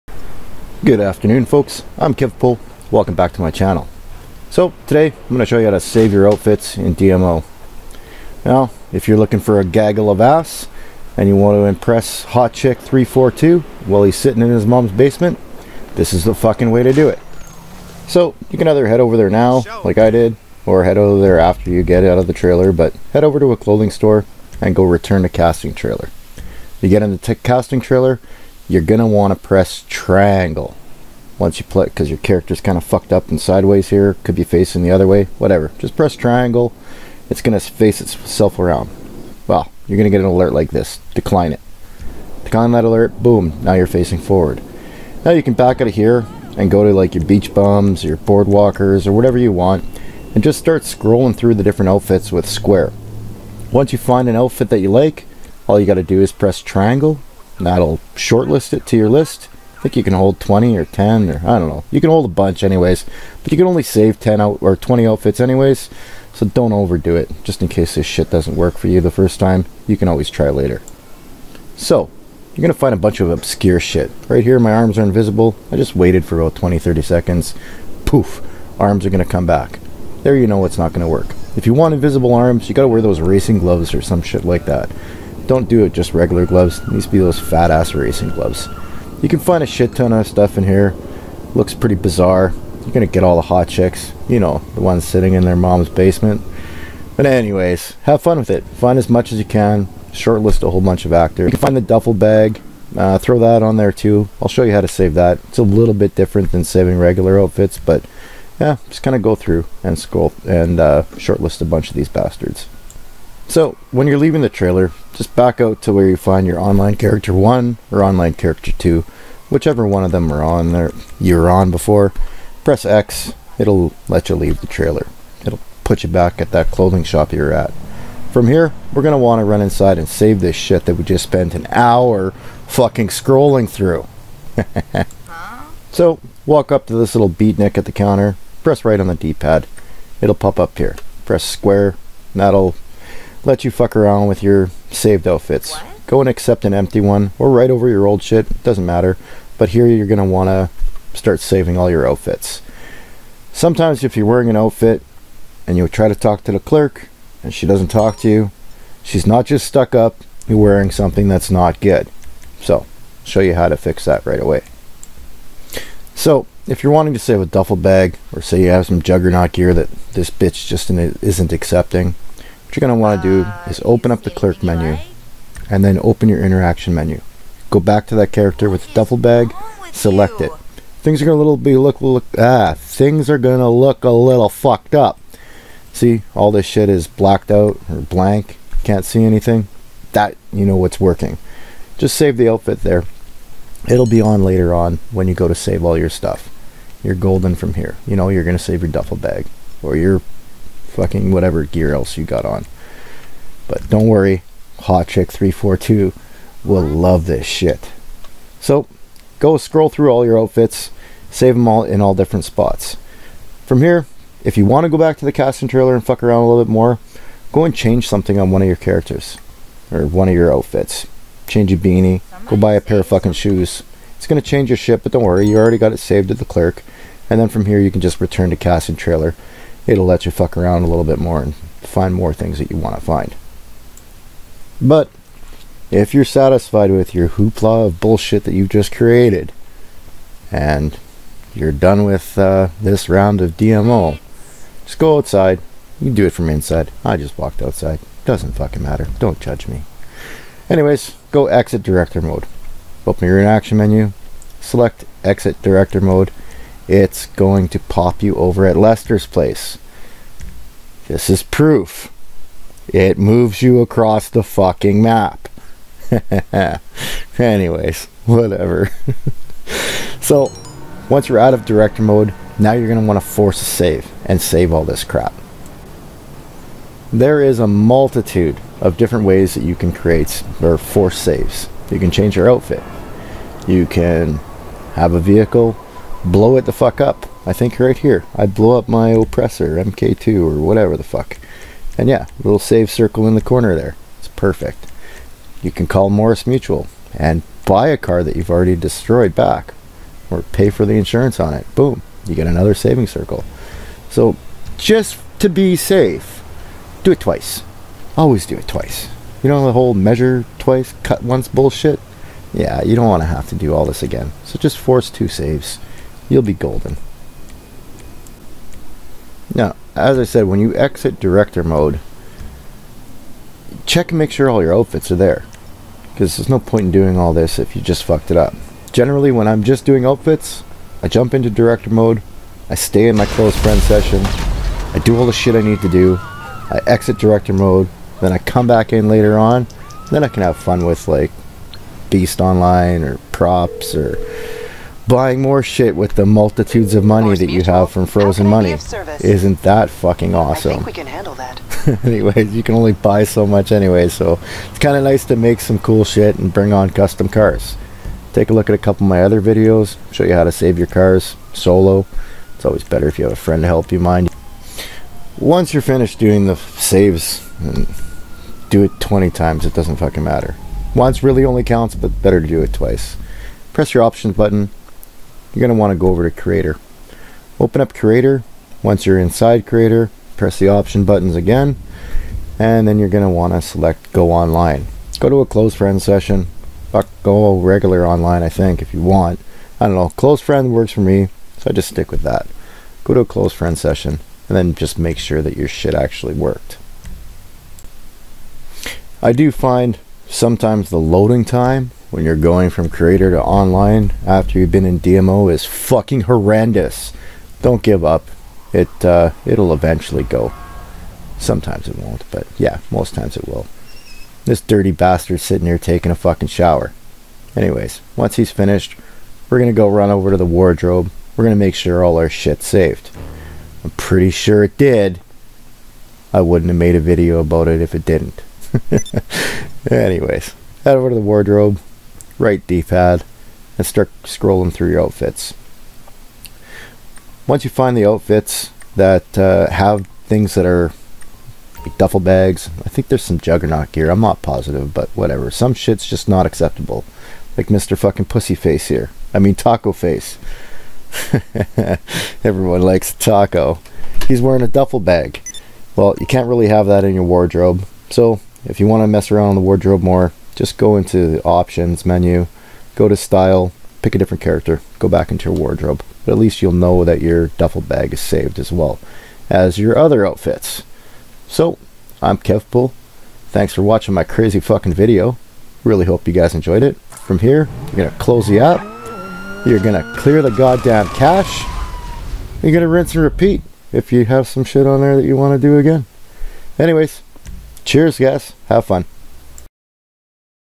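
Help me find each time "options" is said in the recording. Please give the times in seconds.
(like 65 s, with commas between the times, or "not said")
374 s, 380 s, 461 s.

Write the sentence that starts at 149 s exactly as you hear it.
But here you're going to want to start saving all your outfits.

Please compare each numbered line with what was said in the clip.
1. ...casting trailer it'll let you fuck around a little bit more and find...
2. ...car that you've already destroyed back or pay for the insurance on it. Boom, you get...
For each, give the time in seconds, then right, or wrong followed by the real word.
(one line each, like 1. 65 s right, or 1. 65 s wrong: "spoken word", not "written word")
1. 228 s right
2. 297 s right.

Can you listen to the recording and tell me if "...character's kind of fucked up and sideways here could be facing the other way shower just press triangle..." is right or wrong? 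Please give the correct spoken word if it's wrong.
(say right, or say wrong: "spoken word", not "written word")
wrong: "whatever", not "shower".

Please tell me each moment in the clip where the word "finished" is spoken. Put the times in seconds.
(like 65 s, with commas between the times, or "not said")
365 s, 418 s.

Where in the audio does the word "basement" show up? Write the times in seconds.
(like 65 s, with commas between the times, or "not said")
14 s, 95 s.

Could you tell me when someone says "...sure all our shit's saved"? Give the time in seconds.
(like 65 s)
421 s.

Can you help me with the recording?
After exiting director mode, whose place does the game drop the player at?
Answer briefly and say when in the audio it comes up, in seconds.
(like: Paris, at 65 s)
Lester's place, at 258 s.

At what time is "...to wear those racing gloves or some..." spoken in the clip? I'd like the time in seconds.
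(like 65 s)
82 s.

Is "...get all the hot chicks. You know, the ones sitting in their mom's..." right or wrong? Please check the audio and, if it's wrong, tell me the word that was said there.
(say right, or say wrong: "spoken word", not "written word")
right.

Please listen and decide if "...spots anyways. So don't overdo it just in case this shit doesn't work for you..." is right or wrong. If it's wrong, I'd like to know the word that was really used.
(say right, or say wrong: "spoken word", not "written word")
wrong: "outfits", not "spots".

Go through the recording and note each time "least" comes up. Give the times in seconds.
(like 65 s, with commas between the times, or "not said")
466 s.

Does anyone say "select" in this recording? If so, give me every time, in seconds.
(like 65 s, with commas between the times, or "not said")
179 s, 254 s, 383 s.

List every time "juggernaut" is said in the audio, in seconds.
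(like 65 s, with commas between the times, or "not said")
169 s, 443 s.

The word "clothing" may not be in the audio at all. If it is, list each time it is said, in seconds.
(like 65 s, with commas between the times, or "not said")
23 s, 126 s.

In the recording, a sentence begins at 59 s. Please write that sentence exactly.
I think you can hold 20 or 10 or I don't know.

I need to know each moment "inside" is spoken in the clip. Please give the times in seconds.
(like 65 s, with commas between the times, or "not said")
129 s, 246 s, 379 s.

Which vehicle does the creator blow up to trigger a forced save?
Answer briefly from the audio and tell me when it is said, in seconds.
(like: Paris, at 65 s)
Oppressor MK2, at 289 s.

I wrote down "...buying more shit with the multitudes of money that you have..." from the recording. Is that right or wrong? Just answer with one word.
right.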